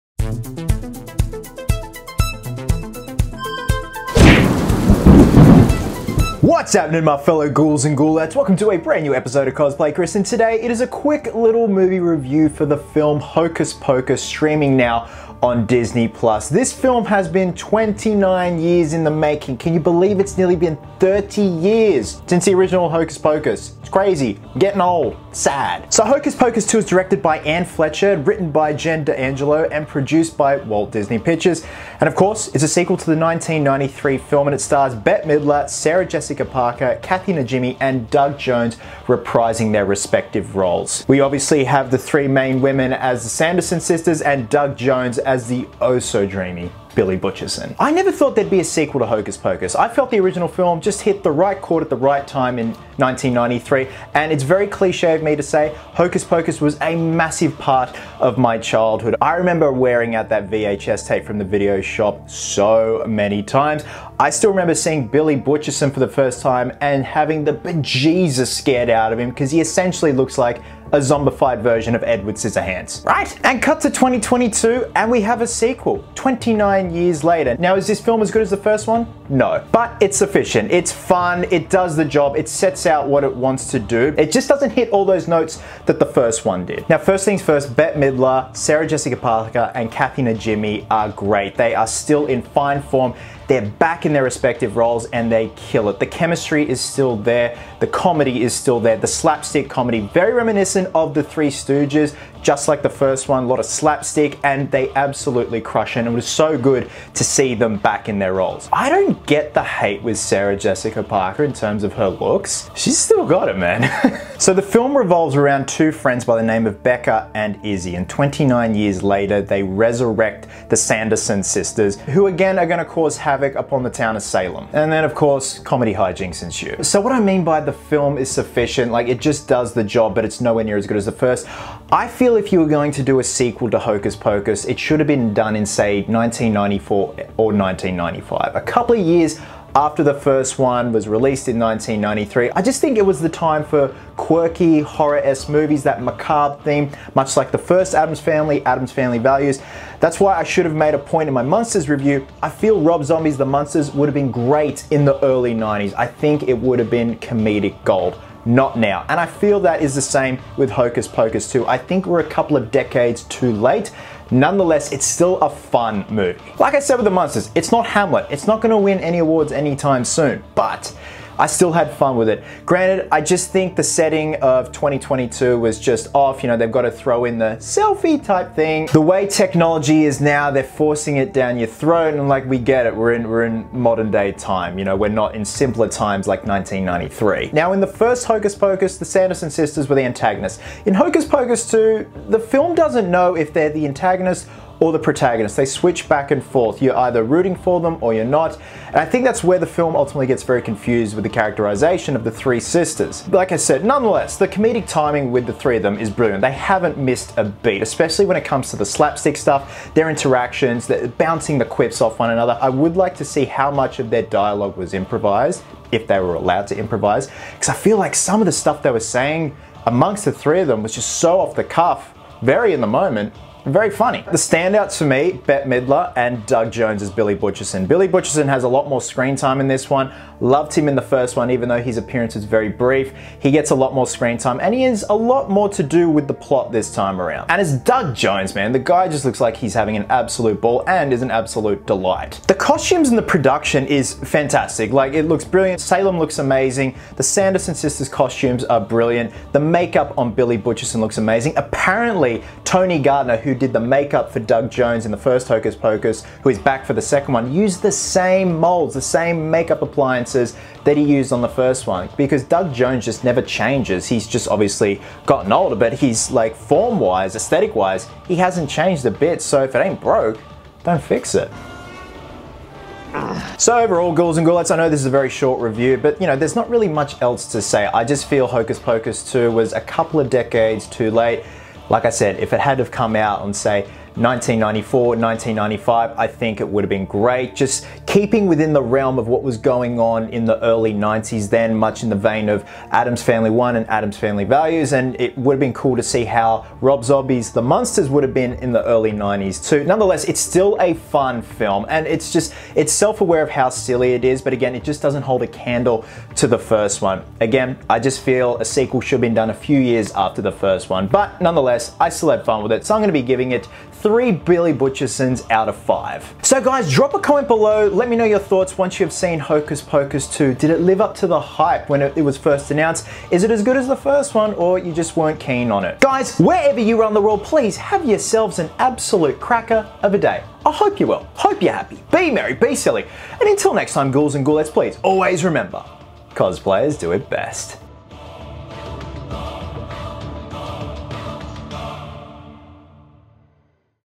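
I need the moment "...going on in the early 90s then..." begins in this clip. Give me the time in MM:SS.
04:49.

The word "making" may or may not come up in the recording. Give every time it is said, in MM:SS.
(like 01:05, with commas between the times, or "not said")
00:19.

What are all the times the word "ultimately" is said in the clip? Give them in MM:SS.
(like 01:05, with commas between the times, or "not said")
03:19.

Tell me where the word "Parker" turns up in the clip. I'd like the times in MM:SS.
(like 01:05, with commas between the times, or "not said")
00:36, 01:29, 01:51.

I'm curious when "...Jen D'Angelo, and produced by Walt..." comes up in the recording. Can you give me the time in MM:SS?
00:28.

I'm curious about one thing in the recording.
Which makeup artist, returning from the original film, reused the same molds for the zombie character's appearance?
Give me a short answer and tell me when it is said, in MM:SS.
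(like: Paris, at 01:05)
Tony Gardner, at 04:12.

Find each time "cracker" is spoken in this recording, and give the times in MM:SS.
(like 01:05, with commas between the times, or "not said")
05:29.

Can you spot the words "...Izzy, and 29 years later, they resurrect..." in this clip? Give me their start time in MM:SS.
01:57.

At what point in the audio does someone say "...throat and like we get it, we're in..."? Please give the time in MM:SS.
03:01.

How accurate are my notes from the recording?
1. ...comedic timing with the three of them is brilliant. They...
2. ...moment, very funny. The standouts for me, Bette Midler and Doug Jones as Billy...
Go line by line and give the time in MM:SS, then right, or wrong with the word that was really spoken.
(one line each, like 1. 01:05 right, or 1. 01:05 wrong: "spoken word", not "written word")
1. 03:24 right
2. 03:42 right.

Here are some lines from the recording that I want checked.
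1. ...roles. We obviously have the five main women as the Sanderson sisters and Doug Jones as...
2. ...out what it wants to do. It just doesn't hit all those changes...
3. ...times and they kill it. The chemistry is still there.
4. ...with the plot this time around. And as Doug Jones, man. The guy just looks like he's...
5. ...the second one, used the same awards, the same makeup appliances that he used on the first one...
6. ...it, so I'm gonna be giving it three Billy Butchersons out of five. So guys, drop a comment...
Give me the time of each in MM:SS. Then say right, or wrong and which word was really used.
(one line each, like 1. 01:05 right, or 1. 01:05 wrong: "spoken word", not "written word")
1. 00:40 wrong: "three", not "five"
2. 01:22 wrong: "notes", not "changes"
3. 01:34 wrong: "roles", not "times"
4. 03:56 right
5. 04:16 wrong: "molds", not "awards"
6. 05:12 right.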